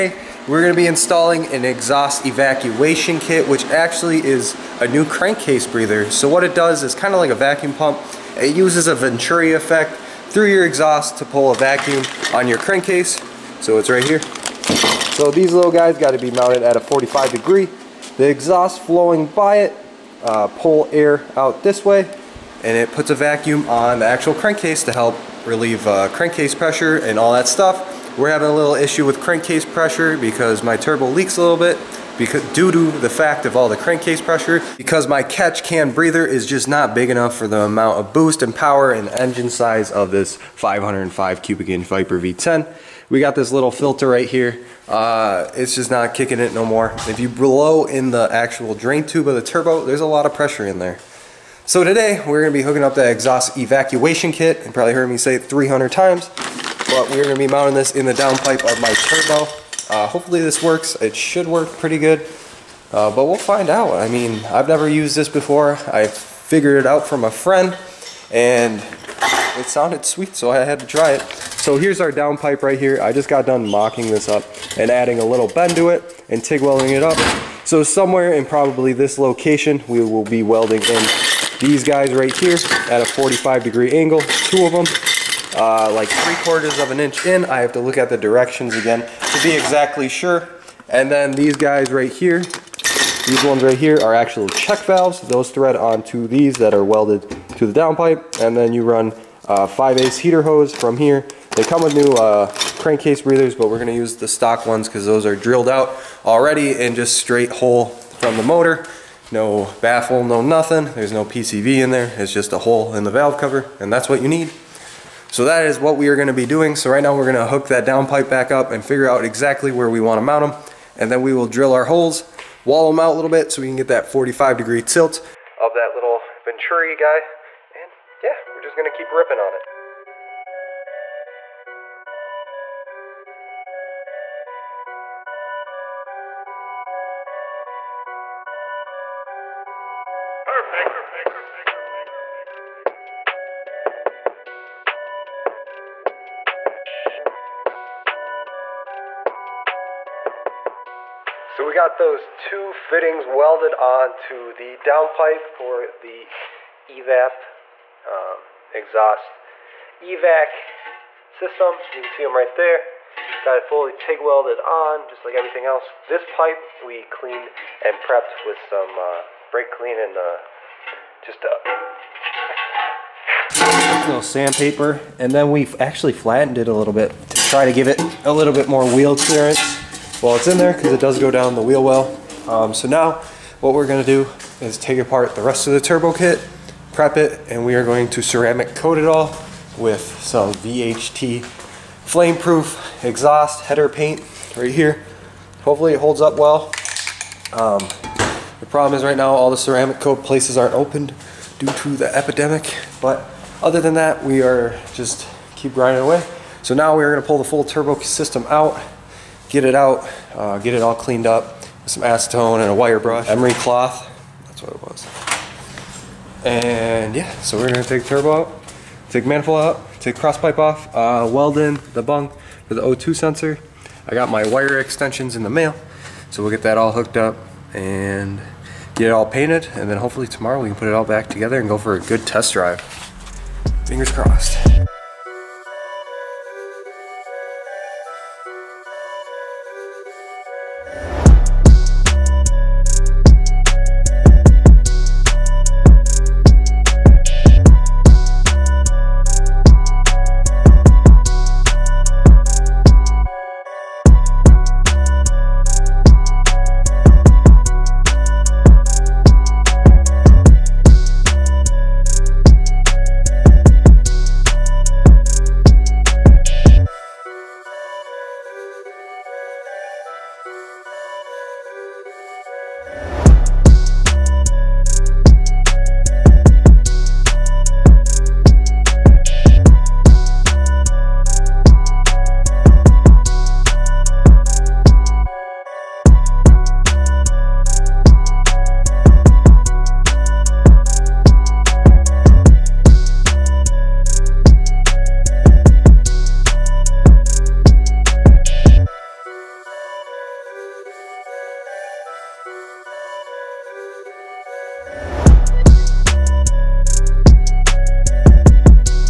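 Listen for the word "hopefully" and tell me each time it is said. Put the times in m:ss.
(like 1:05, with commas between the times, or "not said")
1:00, 3:15, 3:49.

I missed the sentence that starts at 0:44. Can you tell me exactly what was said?
Uh, it's just not kicking it no more.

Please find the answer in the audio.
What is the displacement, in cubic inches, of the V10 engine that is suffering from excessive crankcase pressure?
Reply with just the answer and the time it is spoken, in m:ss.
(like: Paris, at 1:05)
505, at 0:40.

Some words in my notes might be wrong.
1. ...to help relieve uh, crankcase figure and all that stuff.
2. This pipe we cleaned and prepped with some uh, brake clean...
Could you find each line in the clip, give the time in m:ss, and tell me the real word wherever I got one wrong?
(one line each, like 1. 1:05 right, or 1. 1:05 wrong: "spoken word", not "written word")
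1. 0:24 wrong: "pressure", not "figure"
2. 2:46 right.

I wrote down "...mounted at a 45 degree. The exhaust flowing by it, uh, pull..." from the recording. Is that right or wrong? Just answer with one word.
right.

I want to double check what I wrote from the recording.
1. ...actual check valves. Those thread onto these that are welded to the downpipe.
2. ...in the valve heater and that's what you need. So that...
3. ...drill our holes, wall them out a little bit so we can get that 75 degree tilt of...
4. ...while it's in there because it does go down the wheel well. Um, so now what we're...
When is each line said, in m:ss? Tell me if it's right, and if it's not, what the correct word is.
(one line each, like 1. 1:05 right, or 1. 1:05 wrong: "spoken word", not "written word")
1. 1:34 right
2. 1:52 wrong: "cover", not "heater"
3. 2:01 wrong: "45", not "75"
4. 3:00 right.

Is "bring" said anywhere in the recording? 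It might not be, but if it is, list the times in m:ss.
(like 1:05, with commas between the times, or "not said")
not said.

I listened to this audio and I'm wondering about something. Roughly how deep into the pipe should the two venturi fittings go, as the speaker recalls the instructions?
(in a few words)
3/4 of an inch.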